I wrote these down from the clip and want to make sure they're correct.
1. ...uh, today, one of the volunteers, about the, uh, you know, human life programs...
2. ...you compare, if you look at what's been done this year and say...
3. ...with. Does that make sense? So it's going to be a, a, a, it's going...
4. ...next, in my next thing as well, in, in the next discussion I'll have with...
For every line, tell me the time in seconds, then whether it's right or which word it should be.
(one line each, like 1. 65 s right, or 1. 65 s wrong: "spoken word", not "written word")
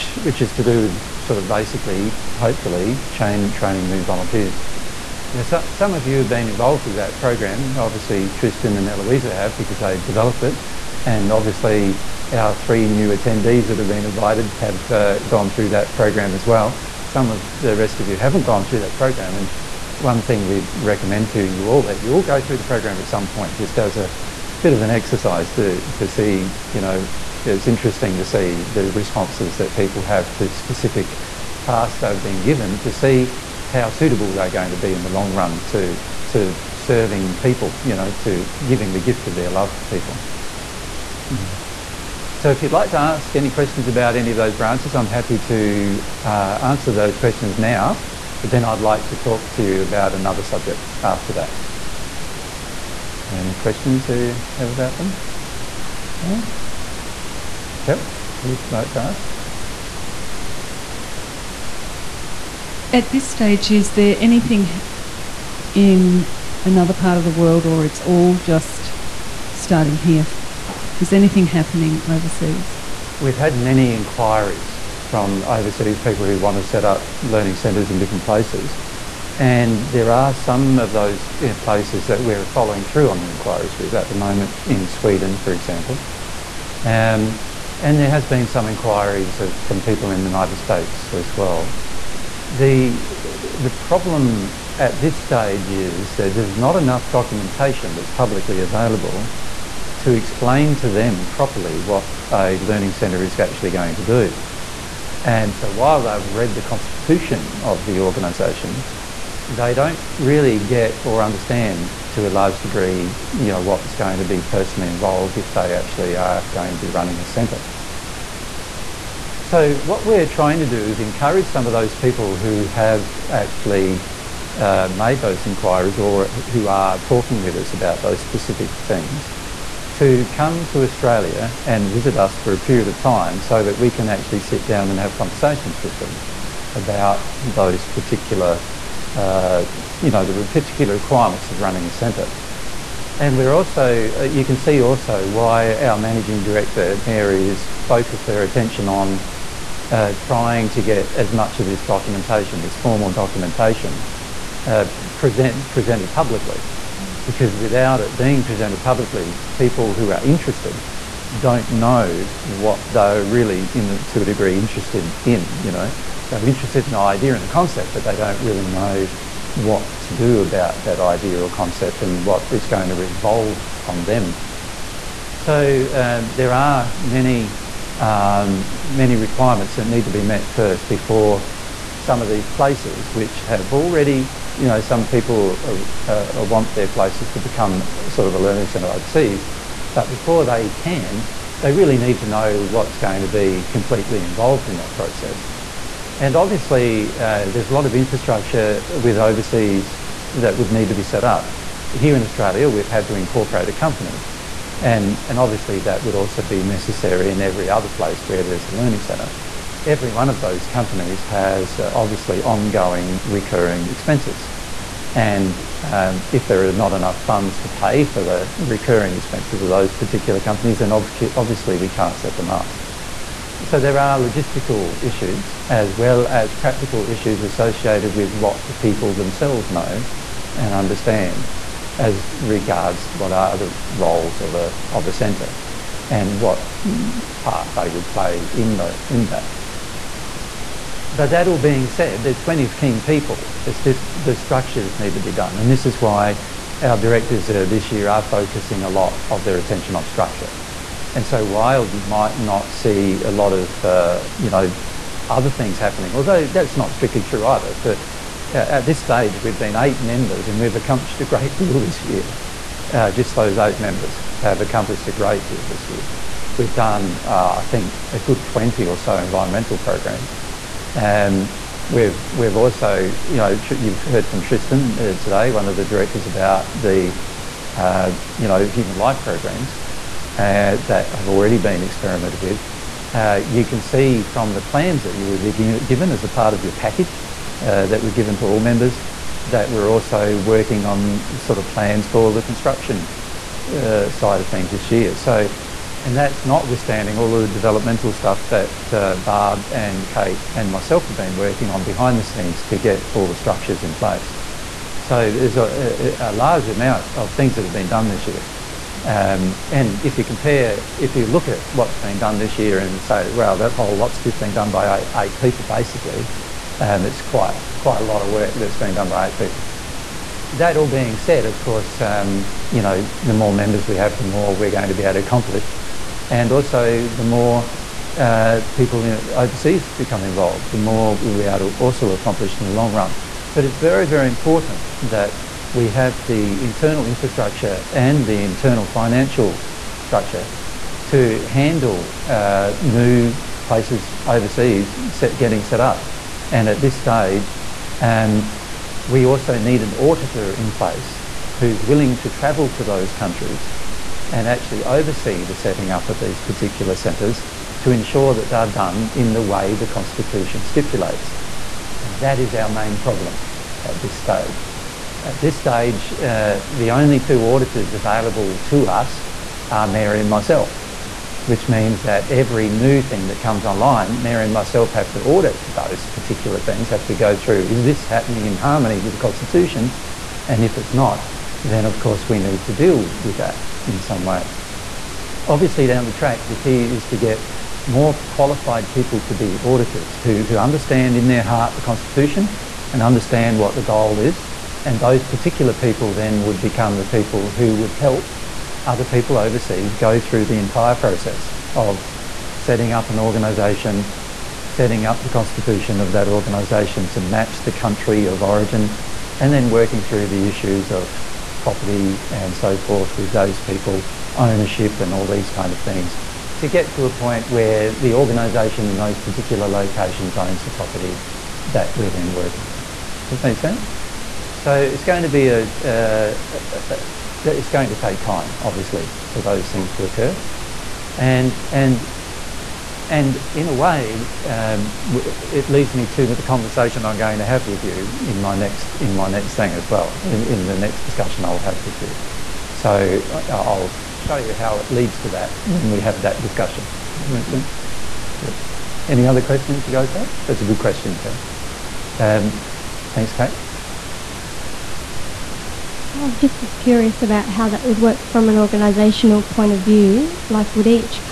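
1. 274 s wrong: "directors", not "volunteers"
2. 310 s right
3. 422 s right
4. 438 s right.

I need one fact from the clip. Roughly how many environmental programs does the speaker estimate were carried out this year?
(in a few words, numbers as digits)
20.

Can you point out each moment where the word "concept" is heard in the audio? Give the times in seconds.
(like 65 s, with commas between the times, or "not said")
167 s, 171 s.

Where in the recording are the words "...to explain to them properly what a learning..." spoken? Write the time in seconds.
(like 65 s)
99 s.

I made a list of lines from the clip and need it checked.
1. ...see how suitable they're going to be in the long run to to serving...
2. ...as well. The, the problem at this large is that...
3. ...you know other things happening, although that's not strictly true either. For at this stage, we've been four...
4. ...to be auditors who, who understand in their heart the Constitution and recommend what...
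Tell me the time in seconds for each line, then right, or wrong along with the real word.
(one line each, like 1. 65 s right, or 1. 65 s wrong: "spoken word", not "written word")
1. 32 s right
2. 91 s wrong: "stage", not "large"
3. 254 s wrong: "eight", not "four"
4. 389 s wrong: "understand", not "recommend".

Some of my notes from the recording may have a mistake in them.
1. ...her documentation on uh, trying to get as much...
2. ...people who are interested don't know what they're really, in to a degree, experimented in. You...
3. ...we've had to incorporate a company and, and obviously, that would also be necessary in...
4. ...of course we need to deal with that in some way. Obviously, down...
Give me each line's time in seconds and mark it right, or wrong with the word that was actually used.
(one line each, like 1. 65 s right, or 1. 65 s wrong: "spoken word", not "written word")
1. 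148 s wrong: "attention", not "documentation"
2. 159 s wrong: "interested", not "experimented"
3. 202 s right
4. 381 s right.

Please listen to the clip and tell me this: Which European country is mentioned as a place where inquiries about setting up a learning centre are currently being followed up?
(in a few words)
Sweden.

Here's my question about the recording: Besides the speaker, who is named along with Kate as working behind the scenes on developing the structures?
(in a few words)
Barb.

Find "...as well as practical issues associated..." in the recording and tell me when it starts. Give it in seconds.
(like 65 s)
225 s.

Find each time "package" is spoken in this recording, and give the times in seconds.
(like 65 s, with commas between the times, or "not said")
286 s.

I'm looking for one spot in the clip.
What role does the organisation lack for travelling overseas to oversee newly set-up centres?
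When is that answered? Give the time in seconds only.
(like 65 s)
349 s.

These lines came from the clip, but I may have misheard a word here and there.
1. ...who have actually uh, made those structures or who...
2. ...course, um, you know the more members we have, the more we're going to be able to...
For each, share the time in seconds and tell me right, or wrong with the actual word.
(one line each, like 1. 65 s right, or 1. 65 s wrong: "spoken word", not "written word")
1. 122 s wrong: "inquiries", not "structures"
2. 321 s right.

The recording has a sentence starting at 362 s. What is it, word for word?
And that is our main problem at this stage.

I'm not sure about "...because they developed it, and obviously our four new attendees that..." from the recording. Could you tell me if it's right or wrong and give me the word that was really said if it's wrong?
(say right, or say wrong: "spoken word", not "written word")
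wrong: "three", not "four".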